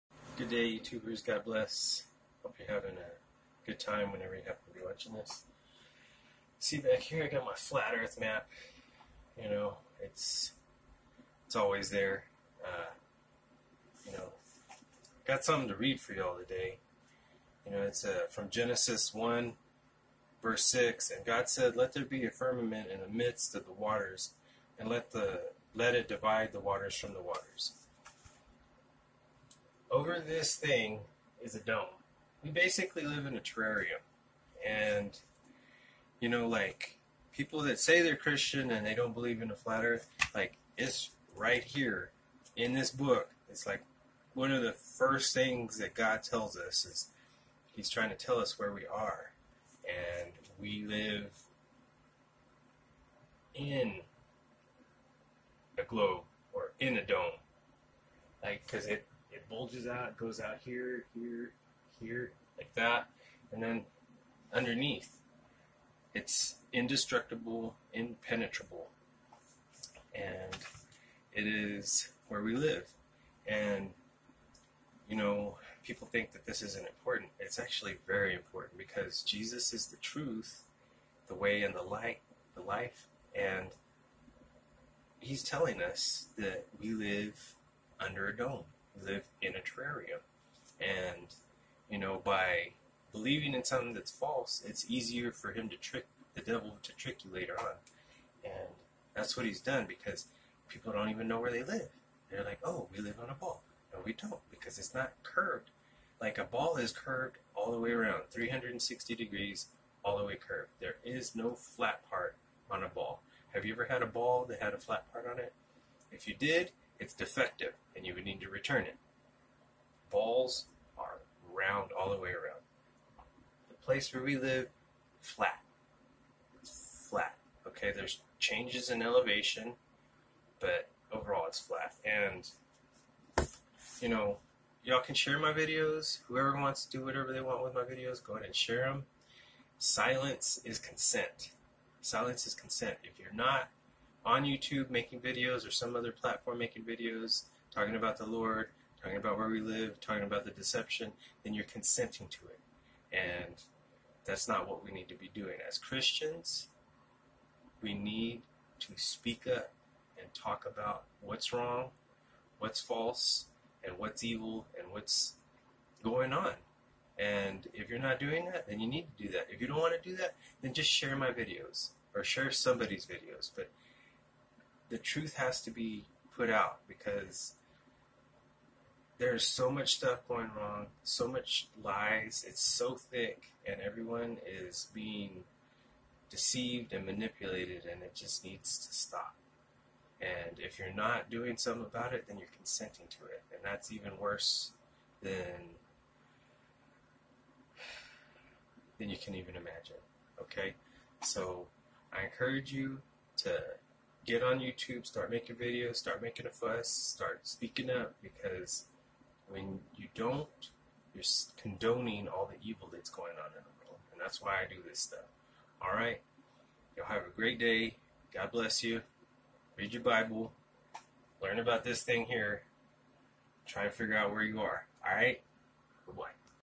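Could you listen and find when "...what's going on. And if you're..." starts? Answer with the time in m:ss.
2:44.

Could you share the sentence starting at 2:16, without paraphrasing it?
Whoever wants to do whatever they want with my videos, go ahead and share them.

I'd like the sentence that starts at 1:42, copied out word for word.
They're like, oh, we live on a ball.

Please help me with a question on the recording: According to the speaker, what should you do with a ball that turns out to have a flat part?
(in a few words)
Return it.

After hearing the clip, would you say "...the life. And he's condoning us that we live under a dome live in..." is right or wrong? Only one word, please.
wrong.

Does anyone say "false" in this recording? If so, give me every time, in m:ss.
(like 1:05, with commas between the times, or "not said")
1:34, 2:42.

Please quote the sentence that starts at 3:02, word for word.
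It's so thick, and everyone is being deceived and manipulated, and it just needs to stop.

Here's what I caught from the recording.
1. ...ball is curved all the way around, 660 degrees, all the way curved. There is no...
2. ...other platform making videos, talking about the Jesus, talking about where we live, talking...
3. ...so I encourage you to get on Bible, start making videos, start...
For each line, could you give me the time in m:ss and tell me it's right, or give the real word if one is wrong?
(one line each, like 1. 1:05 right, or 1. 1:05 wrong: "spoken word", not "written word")
1. 1:46 wrong: "360", not "660"
2. 2:25 wrong: "Lord", not "Jesus"
3. 3:21 wrong: "YouTube", not "Bible".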